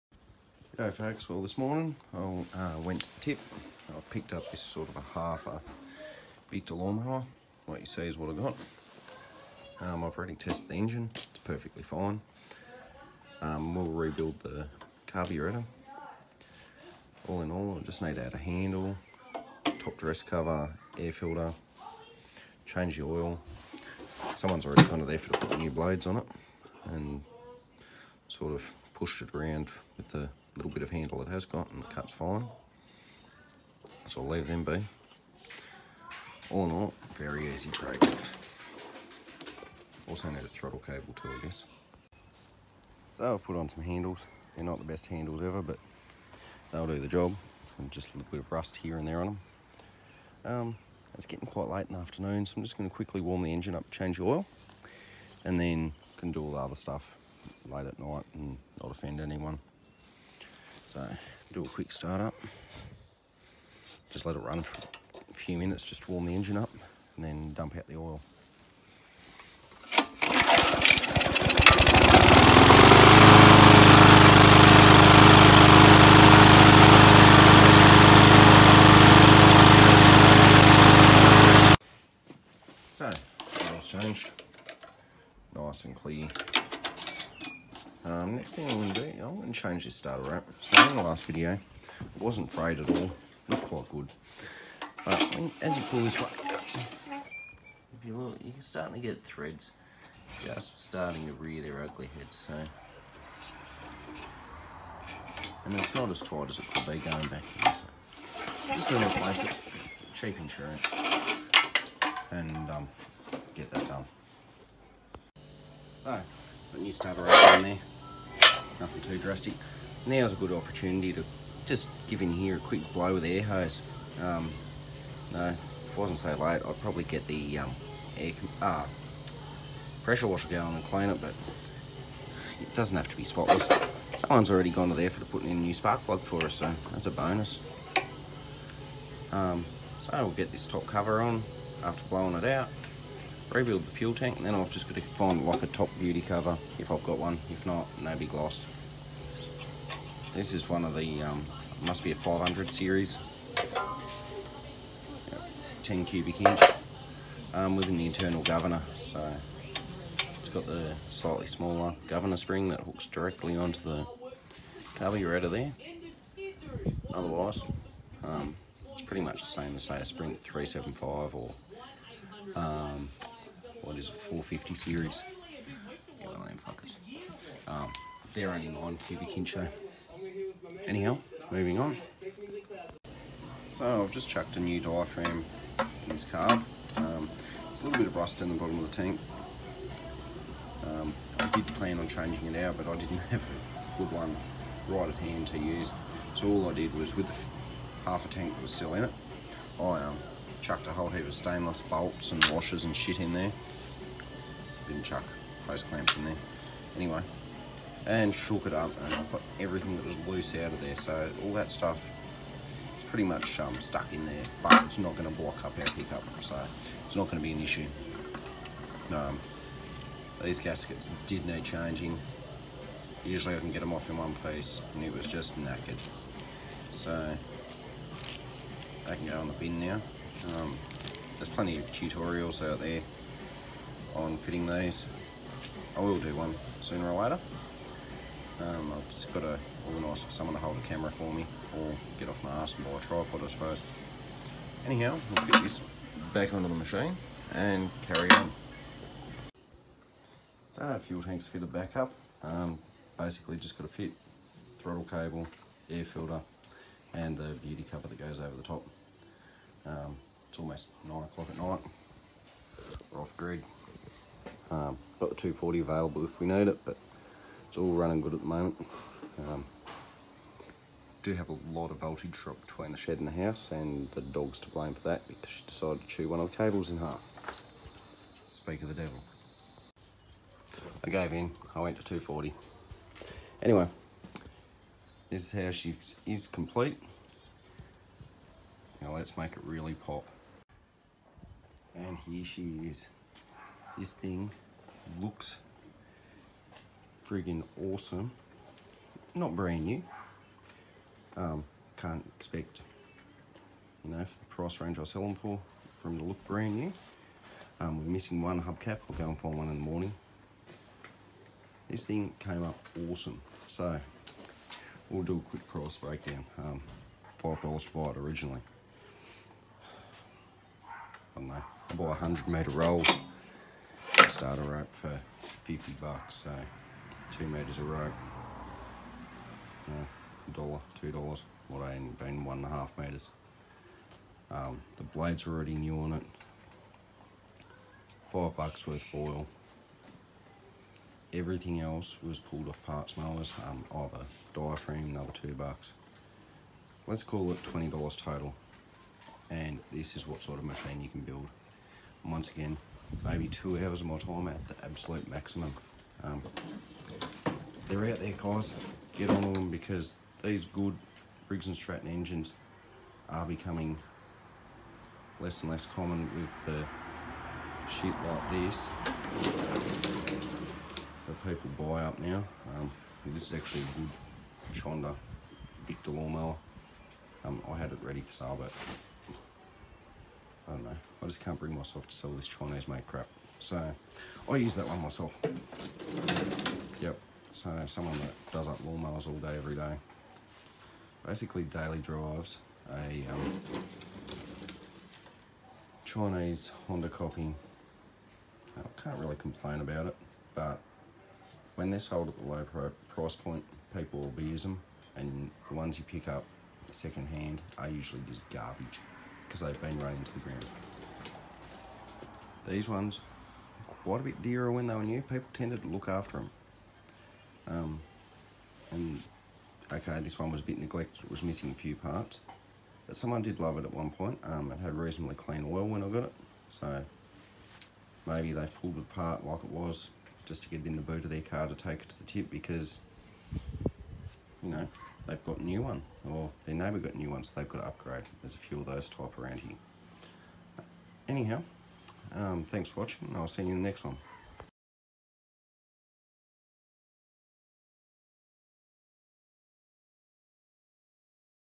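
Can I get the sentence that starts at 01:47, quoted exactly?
So, just going to replace it.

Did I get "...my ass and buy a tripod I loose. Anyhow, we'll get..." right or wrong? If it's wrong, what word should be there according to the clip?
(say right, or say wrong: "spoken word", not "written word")
wrong: "suppose", not "loose".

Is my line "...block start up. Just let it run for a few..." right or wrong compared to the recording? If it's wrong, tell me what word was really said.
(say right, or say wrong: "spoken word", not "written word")
wrong: "quick", not "block".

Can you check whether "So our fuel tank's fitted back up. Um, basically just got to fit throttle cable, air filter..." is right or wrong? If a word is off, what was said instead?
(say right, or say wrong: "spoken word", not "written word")
right.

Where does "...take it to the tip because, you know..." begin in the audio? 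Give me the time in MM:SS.
07:11.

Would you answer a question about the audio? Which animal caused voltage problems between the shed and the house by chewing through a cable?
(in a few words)
dog.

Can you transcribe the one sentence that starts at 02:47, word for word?
Otherwise, um, it's pretty much the same as say a Sprint 375 or um, what is it, 450 series.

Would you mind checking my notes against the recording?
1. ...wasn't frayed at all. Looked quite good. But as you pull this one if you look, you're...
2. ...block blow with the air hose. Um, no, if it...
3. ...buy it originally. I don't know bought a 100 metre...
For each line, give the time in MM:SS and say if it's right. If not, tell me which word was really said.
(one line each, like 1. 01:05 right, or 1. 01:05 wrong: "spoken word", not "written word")
1. 01:32 right
2. 02:02 wrong: "quick", not "block"
3. 05:17 right.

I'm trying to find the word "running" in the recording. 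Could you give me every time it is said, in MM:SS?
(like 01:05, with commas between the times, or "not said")
04:27, 06:49.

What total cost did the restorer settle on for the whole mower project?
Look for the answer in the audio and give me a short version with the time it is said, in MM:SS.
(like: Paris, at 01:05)
$20, at 05:47.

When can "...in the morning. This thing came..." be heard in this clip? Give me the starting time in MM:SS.
05:09.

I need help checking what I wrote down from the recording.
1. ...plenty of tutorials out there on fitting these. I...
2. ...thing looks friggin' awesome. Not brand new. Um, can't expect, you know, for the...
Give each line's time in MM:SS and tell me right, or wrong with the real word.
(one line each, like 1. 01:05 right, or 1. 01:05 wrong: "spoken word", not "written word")
1. 03:51 right
2. 04:54 right.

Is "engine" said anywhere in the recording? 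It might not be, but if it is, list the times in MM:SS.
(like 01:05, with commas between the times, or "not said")
00:10, 00:53, 01:06, 06:02.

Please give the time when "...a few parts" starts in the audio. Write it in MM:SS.
07:01.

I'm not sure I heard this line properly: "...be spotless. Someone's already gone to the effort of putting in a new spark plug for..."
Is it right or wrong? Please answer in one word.
right.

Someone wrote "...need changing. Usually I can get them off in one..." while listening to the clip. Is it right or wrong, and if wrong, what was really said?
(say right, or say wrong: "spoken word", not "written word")
right.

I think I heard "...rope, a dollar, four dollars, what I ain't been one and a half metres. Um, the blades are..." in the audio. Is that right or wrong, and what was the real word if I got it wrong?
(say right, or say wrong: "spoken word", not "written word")
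wrong: "two", not "four".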